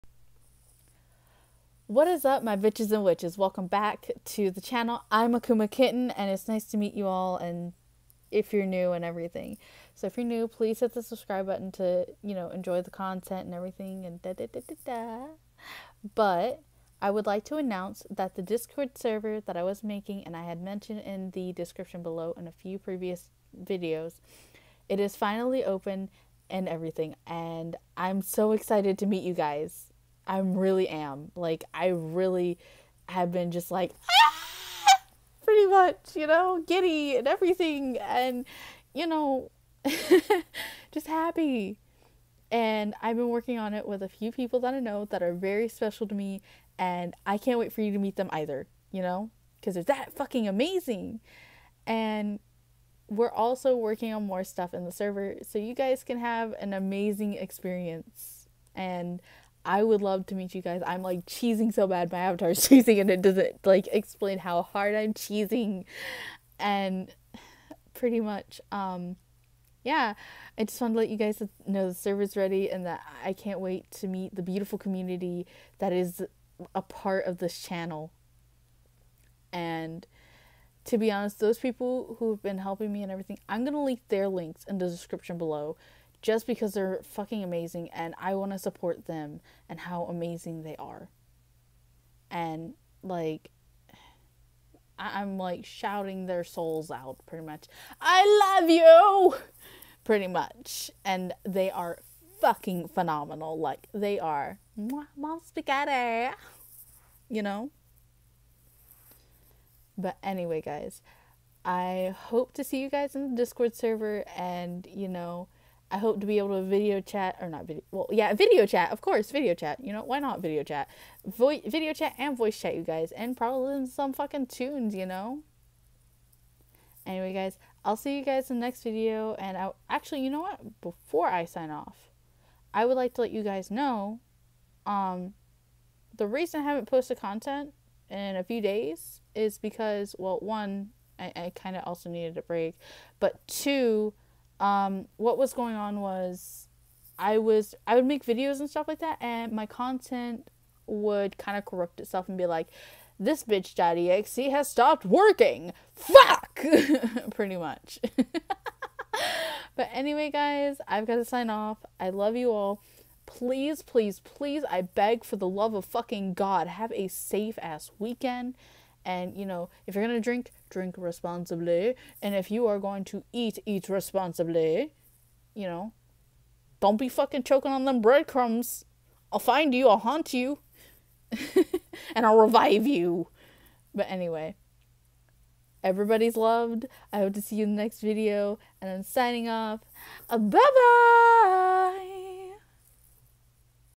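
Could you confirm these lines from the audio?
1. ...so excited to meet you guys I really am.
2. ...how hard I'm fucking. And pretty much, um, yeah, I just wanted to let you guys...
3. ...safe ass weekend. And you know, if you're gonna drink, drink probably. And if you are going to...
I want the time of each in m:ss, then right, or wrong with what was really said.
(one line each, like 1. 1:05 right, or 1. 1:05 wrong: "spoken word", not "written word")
1. 0:28 right
2. 1:04 wrong: "cheesing", not "fucking"
3. 2:47 wrong: "responsibly", not "probably".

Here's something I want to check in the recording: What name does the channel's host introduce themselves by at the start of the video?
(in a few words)
Akuma Kitten.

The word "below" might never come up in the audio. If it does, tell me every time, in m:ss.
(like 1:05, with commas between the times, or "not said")
0:22, 1:25.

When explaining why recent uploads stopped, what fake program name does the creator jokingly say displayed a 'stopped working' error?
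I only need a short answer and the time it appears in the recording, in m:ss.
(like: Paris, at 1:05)
This bitch daddy .exe, at 2:33.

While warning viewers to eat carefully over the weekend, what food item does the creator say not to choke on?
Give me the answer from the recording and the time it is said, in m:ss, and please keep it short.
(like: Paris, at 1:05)
breadcrumbs, at 2:58.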